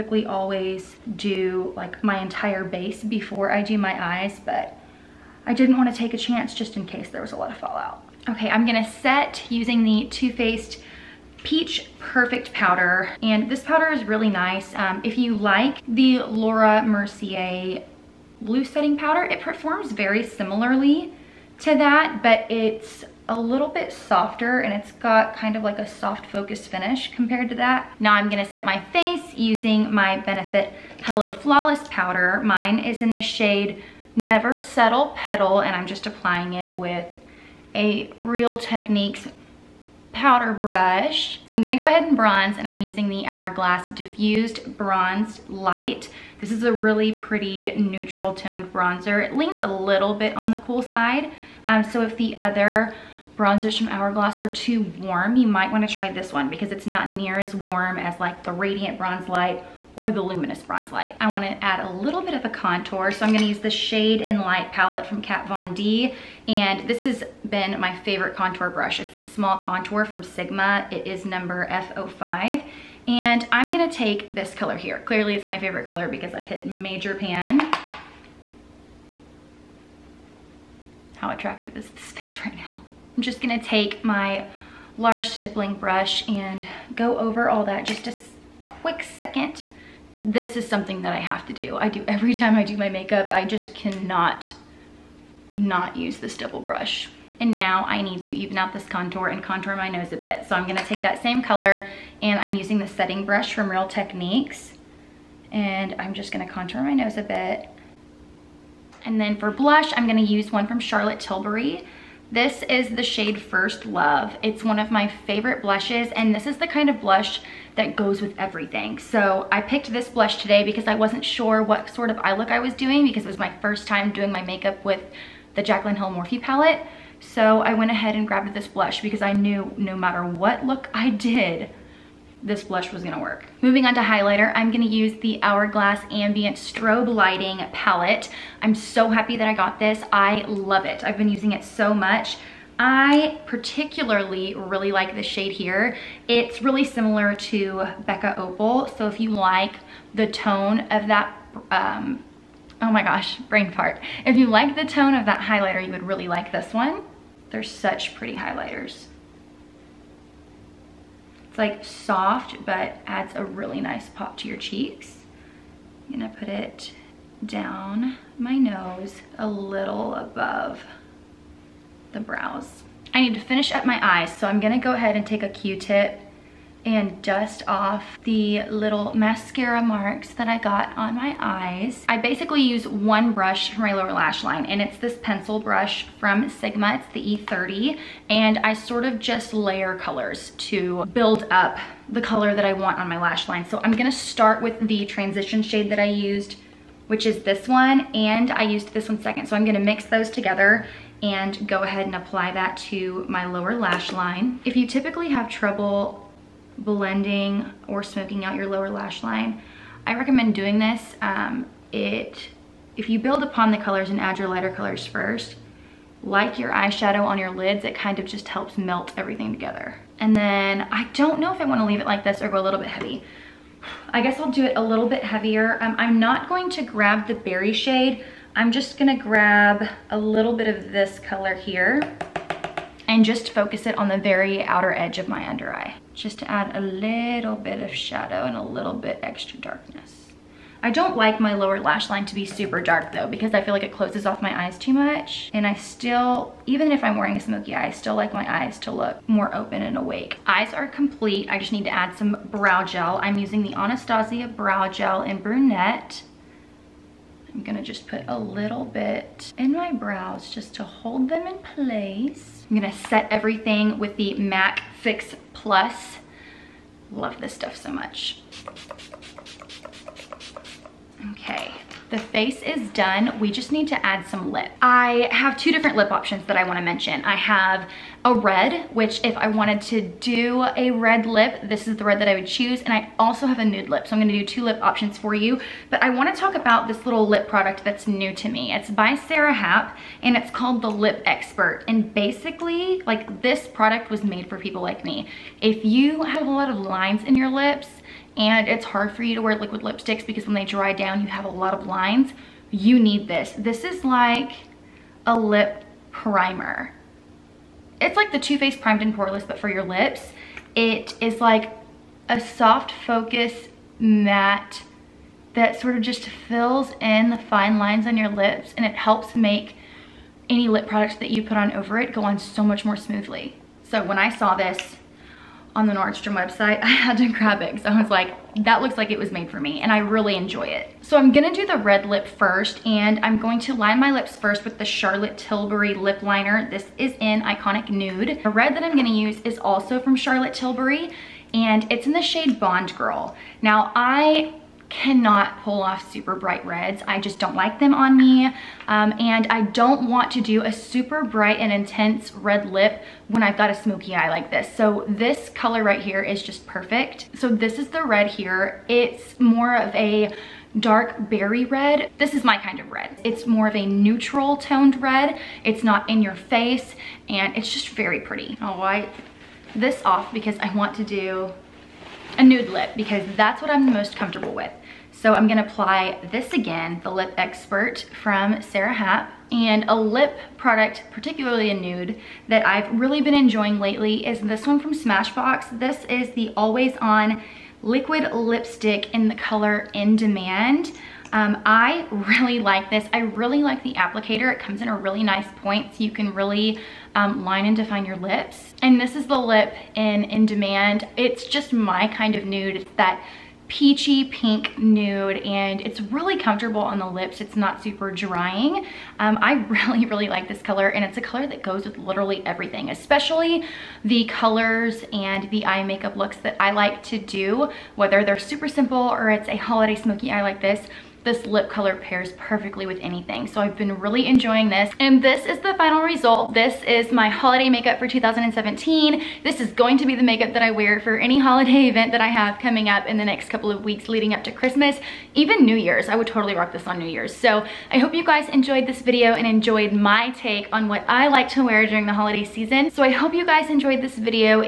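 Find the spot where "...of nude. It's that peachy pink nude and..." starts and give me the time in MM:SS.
06:42.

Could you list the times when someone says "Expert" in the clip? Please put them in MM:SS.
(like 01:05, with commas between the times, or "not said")
04:51, 06:17.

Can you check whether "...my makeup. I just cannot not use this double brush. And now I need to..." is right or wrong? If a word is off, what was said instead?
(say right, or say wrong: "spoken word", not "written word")
right.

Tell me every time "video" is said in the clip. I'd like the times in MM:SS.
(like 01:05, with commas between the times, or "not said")
07:19, 07:24.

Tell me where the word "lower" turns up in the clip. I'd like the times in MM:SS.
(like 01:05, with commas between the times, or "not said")
03:03, 03:23, 03:28, 04:01.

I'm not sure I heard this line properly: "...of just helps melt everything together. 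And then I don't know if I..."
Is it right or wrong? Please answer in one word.
right.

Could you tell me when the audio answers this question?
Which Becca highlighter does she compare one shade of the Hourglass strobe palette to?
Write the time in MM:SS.
02:28.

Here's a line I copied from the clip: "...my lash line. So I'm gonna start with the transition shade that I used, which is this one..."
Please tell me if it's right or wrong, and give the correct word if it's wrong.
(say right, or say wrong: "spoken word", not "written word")
right.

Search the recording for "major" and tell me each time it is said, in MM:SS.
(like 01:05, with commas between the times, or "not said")
01:16.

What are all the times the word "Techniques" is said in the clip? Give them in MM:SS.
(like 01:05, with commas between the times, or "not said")
00:38, 01:43.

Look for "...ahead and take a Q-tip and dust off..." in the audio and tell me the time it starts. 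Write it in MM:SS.
02:54.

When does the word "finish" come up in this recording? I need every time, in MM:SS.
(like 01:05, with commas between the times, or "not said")
00:26, 02:53.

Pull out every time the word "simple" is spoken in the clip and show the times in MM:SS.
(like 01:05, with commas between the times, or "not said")
06:58.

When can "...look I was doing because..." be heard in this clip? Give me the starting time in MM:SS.
02:02.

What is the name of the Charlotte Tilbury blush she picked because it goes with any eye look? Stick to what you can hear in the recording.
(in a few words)
First Love.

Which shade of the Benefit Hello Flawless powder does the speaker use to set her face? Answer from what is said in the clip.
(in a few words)
Never Settle Petal.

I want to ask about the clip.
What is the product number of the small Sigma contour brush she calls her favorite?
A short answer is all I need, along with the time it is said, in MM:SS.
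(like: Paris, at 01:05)
F05, at 01:11.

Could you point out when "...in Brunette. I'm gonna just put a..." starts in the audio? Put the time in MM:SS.
04:15.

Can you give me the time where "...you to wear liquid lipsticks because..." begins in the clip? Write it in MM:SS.
04:59.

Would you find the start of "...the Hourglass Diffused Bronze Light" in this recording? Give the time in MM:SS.
00:43.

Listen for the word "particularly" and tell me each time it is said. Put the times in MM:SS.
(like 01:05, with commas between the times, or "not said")
02:23, 06:21.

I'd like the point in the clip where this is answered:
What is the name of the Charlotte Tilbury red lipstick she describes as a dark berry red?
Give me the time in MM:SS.
05:42.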